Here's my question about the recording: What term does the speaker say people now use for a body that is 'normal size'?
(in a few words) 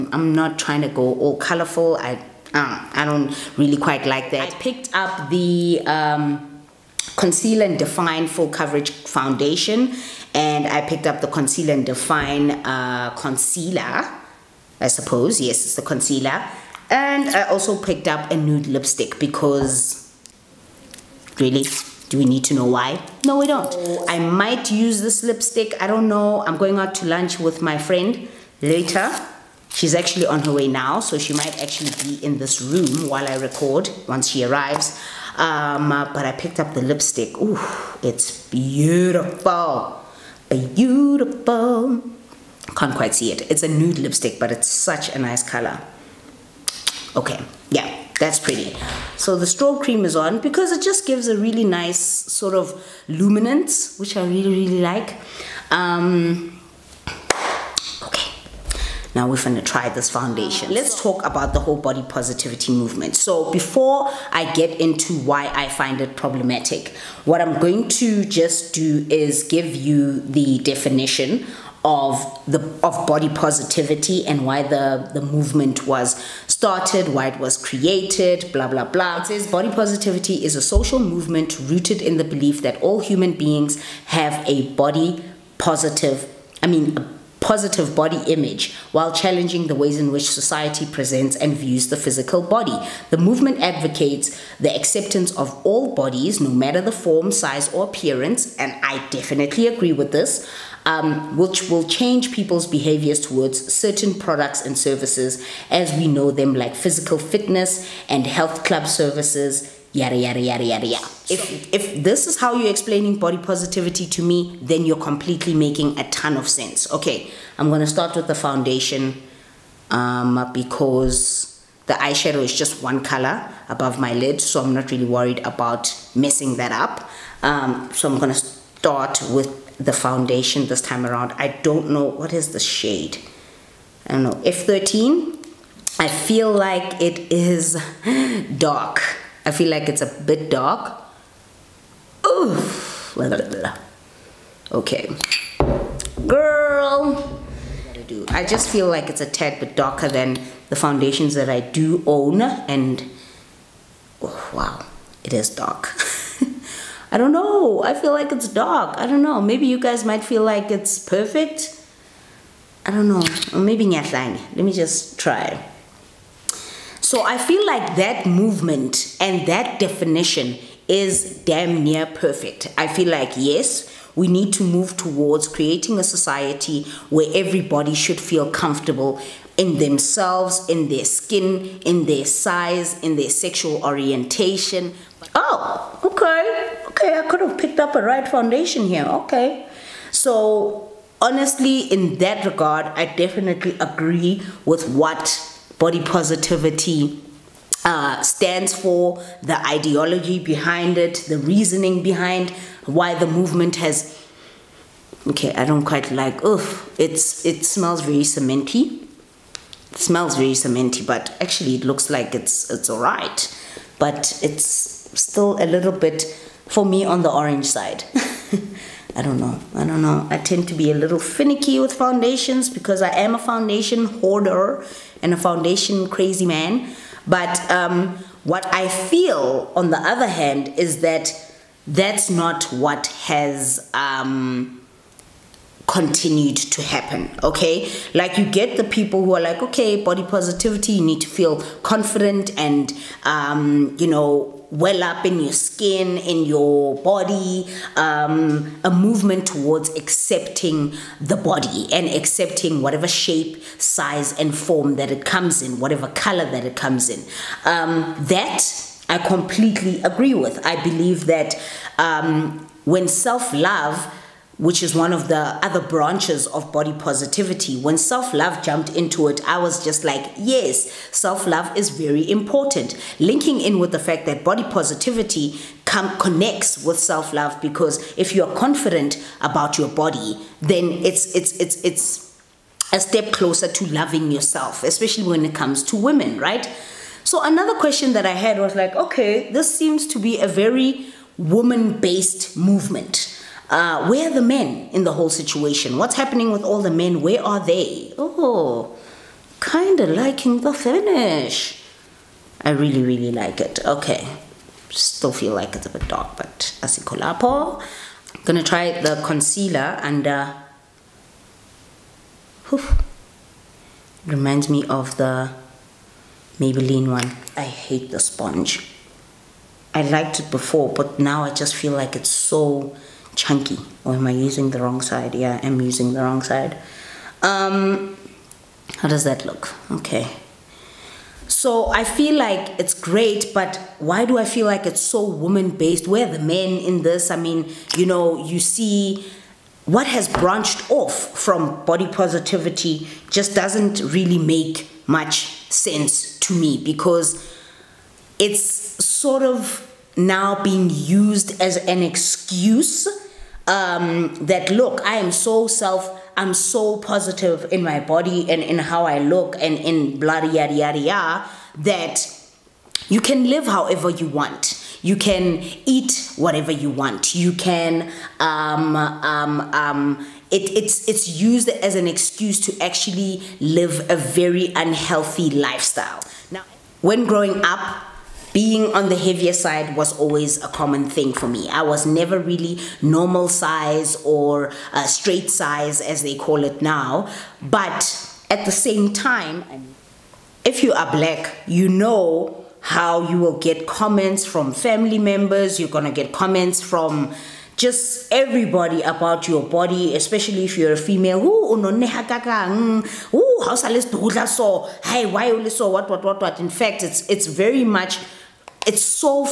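straight size.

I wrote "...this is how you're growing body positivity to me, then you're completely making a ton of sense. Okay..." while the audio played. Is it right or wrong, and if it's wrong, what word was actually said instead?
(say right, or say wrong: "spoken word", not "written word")
wrong: "explaining", not "growing".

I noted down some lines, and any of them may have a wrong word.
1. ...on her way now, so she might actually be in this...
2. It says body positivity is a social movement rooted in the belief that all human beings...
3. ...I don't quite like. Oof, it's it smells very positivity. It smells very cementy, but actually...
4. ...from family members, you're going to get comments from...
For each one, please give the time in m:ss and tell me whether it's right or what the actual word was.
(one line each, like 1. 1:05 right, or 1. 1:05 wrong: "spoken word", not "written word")
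1. 0:30 right
2. 1:19 right
3. 3:25 wrong: "cementy", not "positivity"
4. 6:34 right.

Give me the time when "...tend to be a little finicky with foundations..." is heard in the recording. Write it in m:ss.
3:40.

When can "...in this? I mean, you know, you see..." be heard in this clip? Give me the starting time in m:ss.
5:36.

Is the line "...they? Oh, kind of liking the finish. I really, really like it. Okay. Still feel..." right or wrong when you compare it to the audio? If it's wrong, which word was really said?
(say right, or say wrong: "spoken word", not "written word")
right.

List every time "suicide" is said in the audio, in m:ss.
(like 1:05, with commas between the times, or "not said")
not said.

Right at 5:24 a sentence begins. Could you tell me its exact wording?
Or am I using the wrong side?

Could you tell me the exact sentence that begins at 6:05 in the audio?
You can eat whatever you want.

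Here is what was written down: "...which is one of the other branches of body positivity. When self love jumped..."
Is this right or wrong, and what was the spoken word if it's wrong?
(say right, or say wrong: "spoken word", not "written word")
right.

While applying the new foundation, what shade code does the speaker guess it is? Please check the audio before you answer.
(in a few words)
F13.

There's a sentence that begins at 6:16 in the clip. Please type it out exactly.
Now, when growing up, being on the heavier side was always a common thing for me.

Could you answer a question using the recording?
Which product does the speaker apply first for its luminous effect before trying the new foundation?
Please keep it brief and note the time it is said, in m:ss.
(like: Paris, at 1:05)
strobe cream, at 0:49.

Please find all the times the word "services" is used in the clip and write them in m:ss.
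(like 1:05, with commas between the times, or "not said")
1:44, 1:48.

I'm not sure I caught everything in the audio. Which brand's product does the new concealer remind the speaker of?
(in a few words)
Maybelline.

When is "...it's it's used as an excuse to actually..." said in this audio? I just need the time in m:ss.
6:10.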